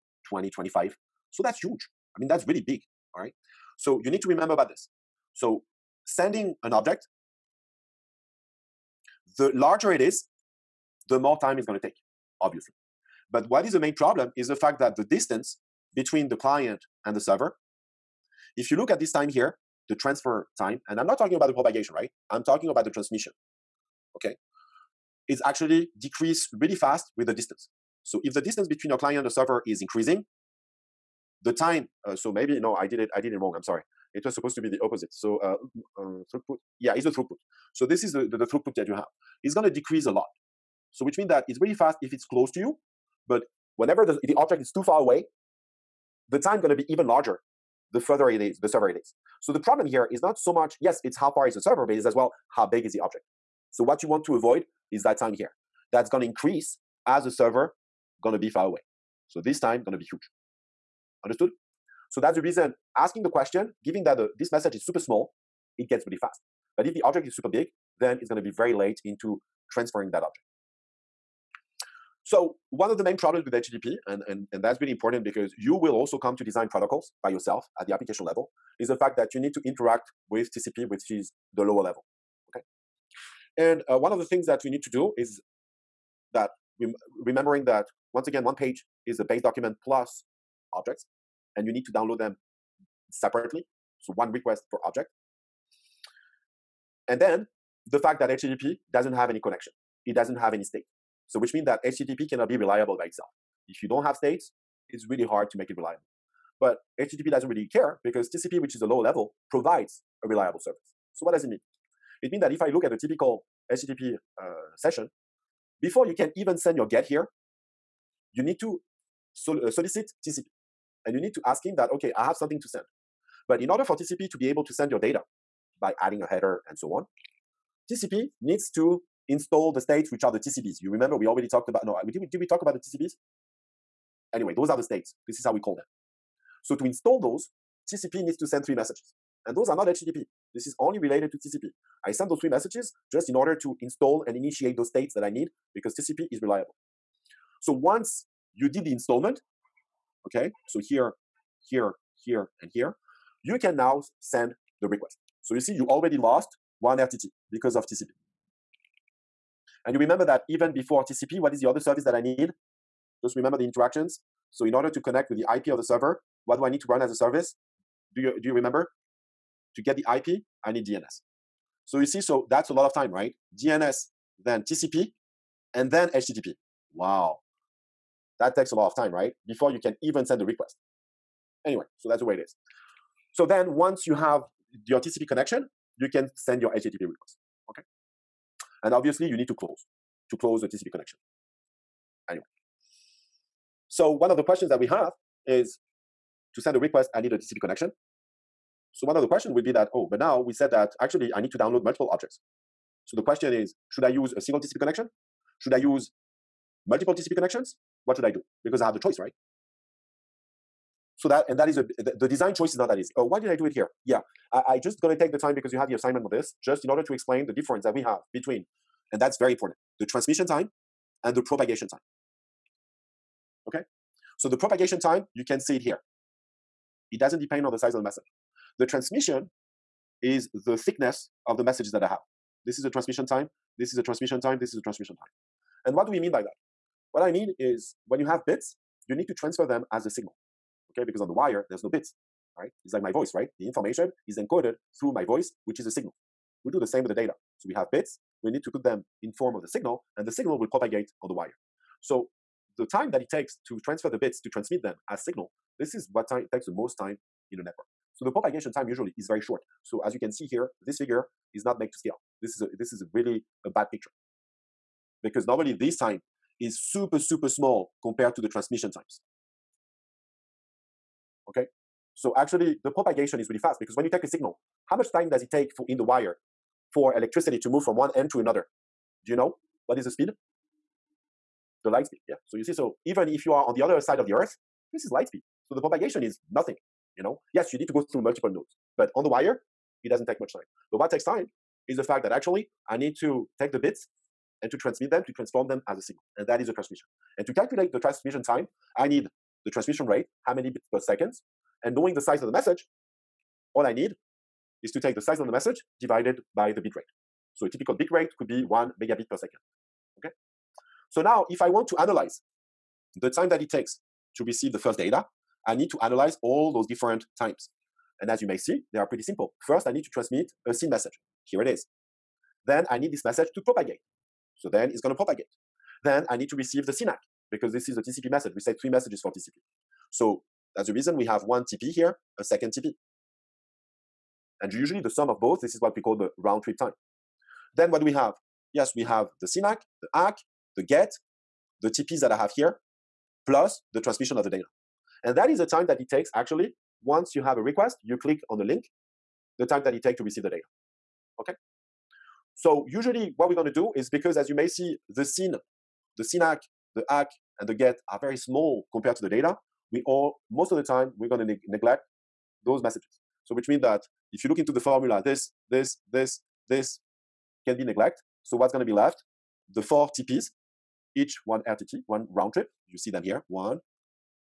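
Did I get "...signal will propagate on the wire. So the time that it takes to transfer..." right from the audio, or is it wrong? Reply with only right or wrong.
right.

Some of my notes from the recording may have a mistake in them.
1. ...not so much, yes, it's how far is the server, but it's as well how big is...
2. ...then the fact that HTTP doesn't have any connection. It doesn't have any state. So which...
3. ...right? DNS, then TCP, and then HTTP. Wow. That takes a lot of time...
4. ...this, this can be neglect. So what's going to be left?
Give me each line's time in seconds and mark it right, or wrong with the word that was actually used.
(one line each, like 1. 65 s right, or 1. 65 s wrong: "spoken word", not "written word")
1. 50 s right
2. 97 s right
3. 173 s right
4. 366 s right.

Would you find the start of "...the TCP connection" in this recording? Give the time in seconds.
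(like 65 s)
190 s.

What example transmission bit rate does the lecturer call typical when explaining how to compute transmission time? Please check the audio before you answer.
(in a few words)
1 megabit per second.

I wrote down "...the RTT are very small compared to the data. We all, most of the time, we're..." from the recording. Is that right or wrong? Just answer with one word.
wrong.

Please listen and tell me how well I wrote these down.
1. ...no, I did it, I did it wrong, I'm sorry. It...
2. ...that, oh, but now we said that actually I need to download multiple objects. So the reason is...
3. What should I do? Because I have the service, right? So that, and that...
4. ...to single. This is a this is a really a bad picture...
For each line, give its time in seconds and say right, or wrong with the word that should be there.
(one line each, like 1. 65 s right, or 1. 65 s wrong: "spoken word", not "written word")
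1. 32 s right
2. 199 s wrong: "question", not "reason"
3. 208 s wrong: "choice", not "service"
4. 261 s wrong: "scale", not "single".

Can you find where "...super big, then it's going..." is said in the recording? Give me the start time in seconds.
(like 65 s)
67 s.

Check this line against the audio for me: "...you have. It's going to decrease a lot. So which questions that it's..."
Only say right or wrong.
wrong.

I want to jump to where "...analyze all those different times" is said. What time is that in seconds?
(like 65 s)
316 s.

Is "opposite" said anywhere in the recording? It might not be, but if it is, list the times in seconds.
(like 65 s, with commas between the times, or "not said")
34 s.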